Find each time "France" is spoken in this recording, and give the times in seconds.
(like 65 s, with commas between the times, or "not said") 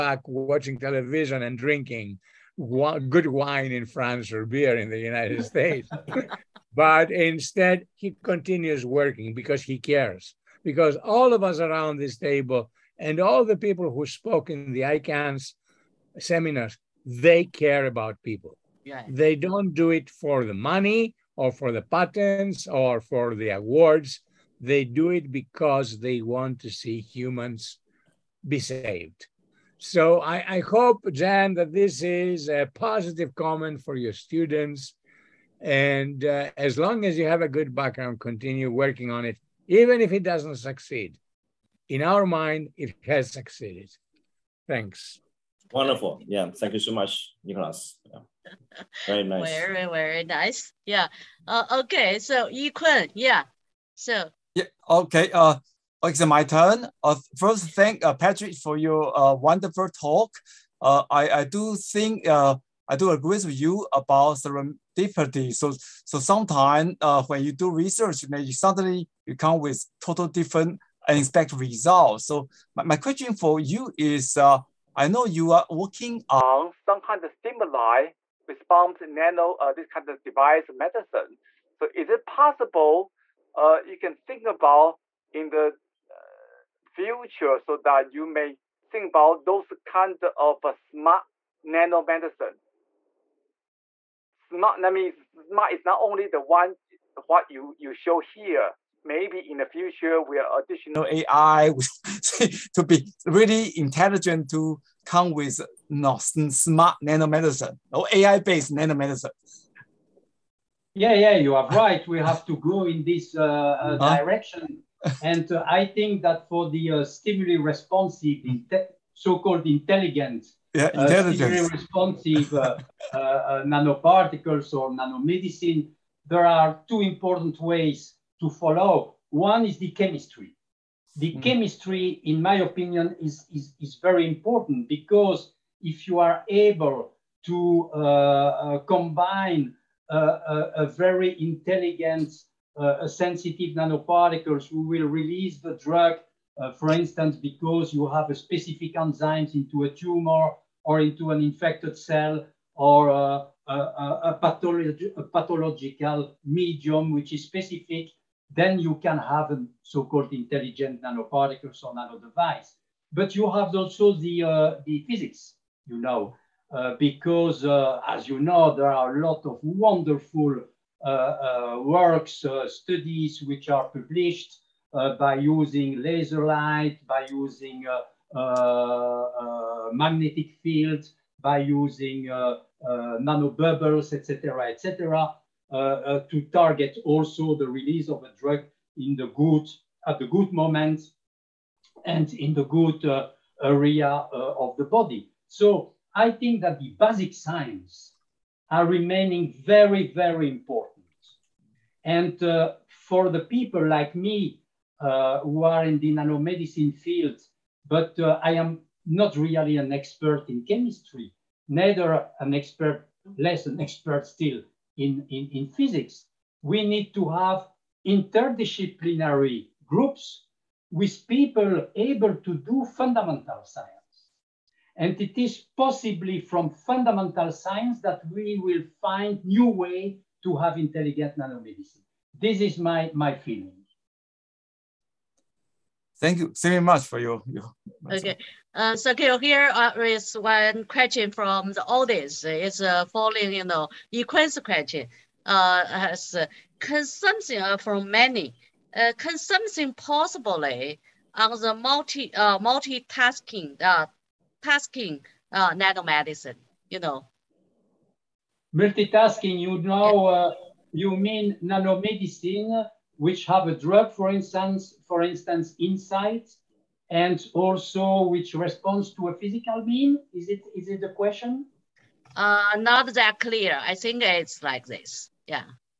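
3 s.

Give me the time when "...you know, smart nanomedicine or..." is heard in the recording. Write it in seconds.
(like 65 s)
105 s.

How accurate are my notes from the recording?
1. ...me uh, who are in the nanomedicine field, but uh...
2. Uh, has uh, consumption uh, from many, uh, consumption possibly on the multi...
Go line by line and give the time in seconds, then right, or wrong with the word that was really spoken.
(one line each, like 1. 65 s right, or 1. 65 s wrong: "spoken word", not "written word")
1. 204 s right
2. 245 s right.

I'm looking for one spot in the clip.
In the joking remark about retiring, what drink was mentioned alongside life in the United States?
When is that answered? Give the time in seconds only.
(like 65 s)
4 s.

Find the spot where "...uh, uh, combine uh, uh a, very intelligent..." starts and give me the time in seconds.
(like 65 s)
137 s.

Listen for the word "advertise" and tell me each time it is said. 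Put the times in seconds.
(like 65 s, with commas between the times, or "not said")
not said.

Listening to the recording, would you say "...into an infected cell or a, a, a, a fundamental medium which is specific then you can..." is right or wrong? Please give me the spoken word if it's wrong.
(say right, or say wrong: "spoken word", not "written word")
wrong: "pathological", not "fundamental".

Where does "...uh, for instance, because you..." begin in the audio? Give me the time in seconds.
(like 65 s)
146 s.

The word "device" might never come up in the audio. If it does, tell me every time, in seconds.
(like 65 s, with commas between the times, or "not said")
80 s, 162 s.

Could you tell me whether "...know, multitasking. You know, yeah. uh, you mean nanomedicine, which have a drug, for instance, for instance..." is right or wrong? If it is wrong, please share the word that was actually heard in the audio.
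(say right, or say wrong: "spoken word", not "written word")
right.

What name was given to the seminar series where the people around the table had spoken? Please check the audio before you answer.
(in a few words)
iCANX.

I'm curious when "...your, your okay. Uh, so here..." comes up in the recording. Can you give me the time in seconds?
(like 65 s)
237 s.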